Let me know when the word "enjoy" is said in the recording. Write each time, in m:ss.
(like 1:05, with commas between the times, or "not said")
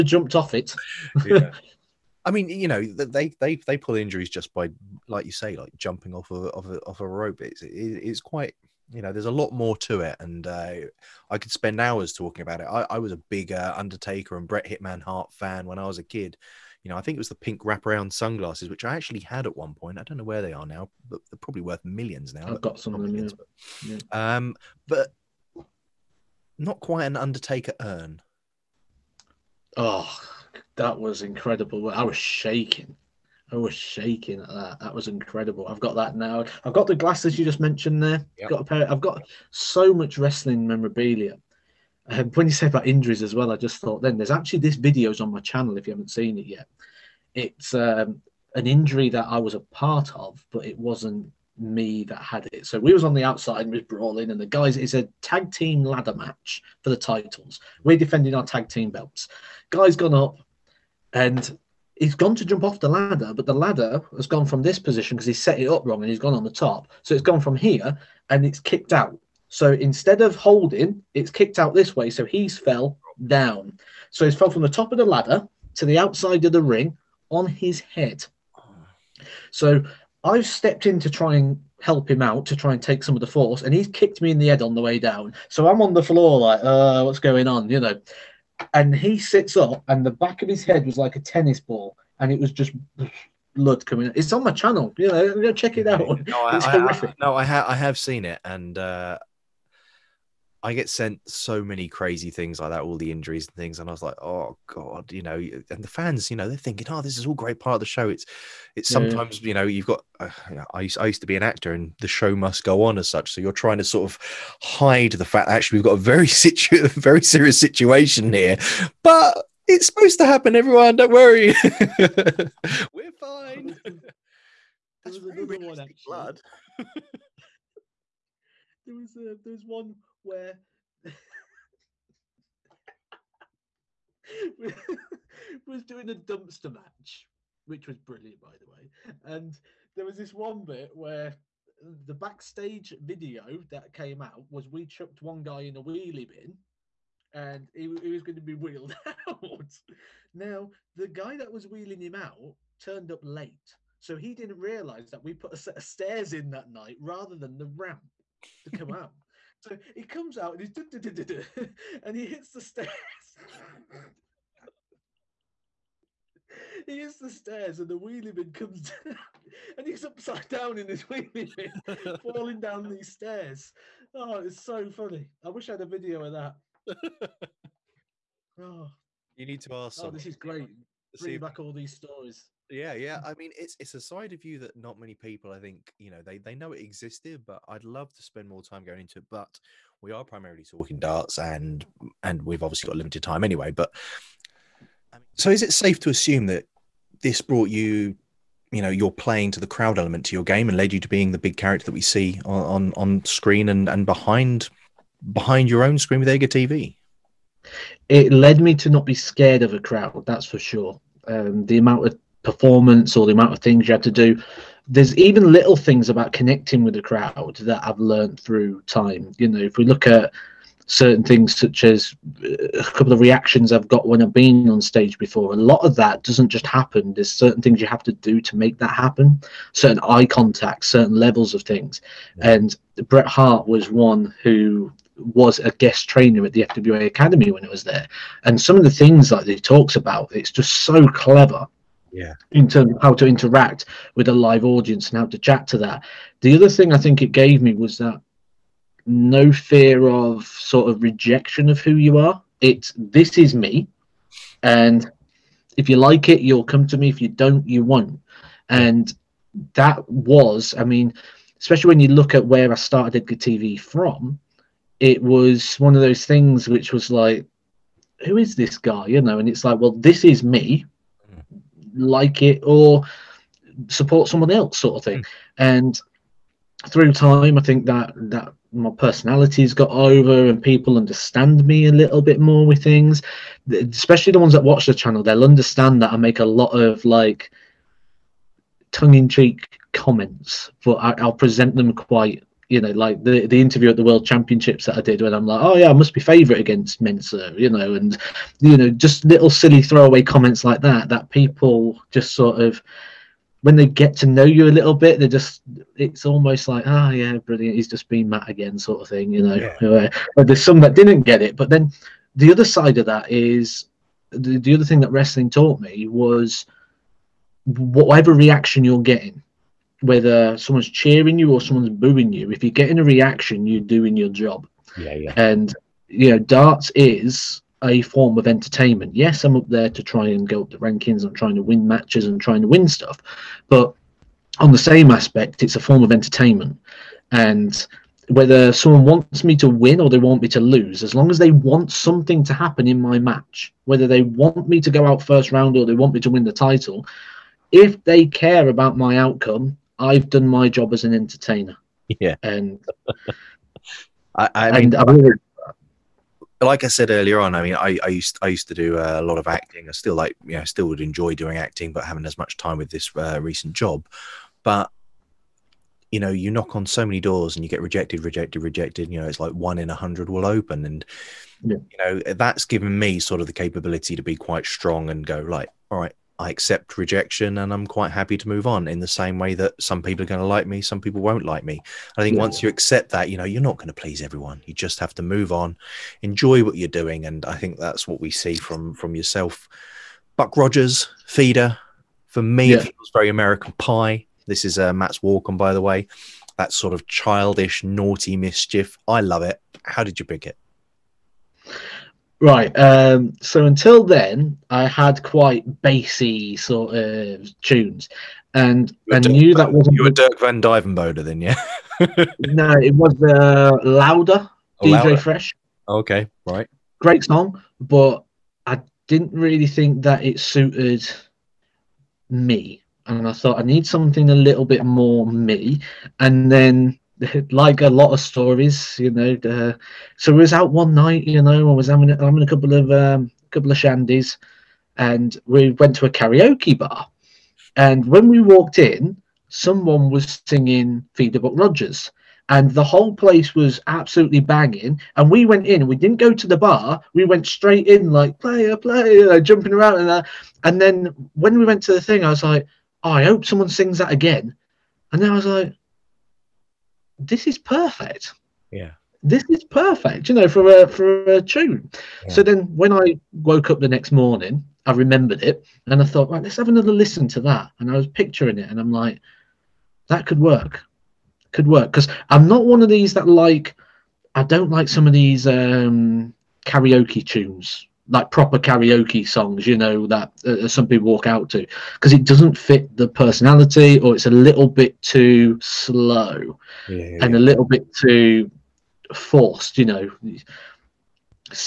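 6:01, 6:26.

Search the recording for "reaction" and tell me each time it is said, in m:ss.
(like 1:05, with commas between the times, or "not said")
3:43, 5:18, 5:23.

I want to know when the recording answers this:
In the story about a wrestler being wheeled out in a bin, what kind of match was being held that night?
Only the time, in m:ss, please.
2:16.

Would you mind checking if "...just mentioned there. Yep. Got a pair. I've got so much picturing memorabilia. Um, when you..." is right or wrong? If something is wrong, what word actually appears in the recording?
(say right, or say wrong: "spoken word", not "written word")
wrong: "wrestling", not "picturing".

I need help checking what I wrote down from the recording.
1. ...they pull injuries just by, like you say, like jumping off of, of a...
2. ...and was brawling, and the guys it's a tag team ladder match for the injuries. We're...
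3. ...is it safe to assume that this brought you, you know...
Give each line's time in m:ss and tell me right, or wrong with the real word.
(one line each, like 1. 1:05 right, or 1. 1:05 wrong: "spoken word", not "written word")
1. 0:03 right
2. 0:53 wrong: "titles", not "injuries"
3. 3:15 right.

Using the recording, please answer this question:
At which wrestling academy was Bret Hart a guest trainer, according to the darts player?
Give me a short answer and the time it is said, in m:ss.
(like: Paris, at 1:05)
FWA Academy, at 3:56.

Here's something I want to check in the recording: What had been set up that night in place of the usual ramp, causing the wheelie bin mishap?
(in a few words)
a set of stairs.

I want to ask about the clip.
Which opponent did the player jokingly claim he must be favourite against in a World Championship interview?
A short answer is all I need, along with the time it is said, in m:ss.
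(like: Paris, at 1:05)
Mensah, at 4:57.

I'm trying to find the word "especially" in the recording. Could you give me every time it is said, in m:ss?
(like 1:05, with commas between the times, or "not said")
4:21, 4:43.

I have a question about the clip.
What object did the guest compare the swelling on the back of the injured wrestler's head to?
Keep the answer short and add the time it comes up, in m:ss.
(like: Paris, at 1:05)
a tennis ball, at 1:31.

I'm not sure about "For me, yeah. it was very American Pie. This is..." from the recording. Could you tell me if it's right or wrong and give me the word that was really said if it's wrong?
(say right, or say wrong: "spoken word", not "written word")
right.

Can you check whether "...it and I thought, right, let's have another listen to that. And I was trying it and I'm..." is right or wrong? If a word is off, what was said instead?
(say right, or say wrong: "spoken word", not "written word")
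wrong: "picturing", not "trying".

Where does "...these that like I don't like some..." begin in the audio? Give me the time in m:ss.
7:52.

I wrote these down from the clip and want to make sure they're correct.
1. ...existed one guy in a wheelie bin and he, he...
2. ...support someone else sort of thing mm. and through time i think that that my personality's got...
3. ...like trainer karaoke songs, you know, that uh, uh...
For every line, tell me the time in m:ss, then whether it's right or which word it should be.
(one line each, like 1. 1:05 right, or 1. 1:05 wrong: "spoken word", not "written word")
1. 2:24 wrong: "chucked", not "existed"
2. 4:33 right
3. 7:58 wrong: "proper", not "trainer".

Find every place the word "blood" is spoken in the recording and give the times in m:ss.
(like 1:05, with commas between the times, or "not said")
1:33, 2:06.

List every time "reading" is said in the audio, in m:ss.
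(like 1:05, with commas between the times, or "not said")
not said.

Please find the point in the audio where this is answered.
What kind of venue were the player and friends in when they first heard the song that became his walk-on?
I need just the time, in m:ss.
7:16.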